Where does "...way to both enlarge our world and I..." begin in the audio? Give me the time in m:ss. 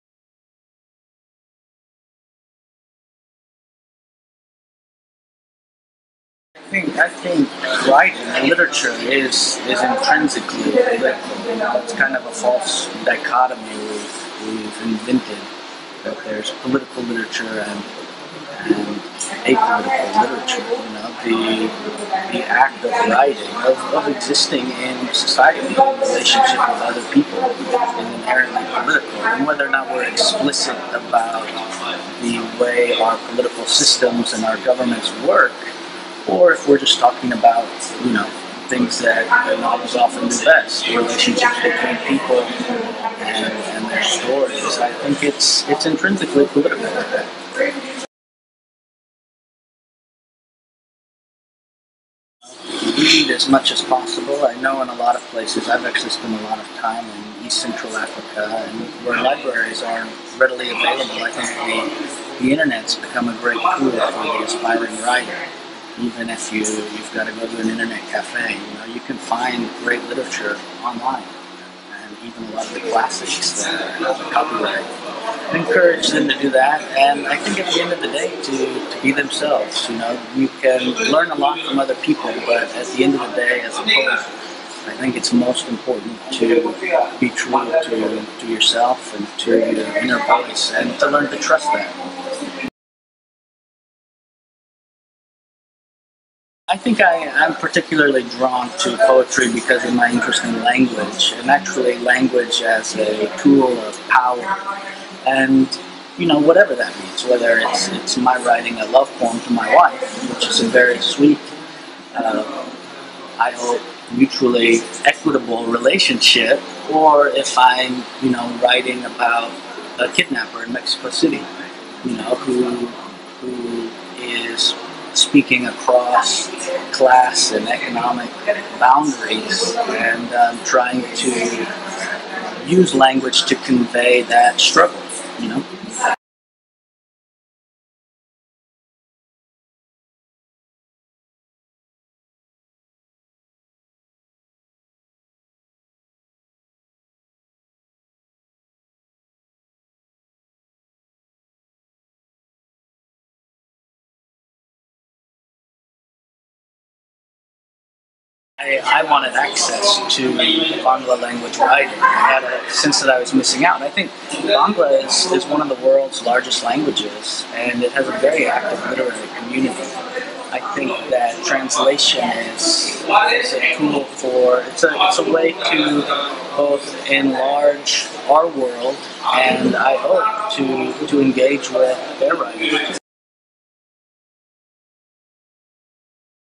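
2:55.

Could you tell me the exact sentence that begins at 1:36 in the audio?
I think I, am particularly drawn to poetry because of my interest in language, and actually language as a tool of power.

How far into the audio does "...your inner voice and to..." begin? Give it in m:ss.
1:29.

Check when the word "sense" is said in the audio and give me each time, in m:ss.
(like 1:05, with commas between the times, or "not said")
2:42.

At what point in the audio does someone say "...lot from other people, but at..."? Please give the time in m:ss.
1:21.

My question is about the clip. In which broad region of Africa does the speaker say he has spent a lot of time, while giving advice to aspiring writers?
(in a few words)
East Central Africa.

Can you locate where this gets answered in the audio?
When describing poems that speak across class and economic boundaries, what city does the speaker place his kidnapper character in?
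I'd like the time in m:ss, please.
2:00.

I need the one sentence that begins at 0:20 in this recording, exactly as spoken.
You know, the the act of writing, of, of existing in society, in relationship with other people, is inherently political.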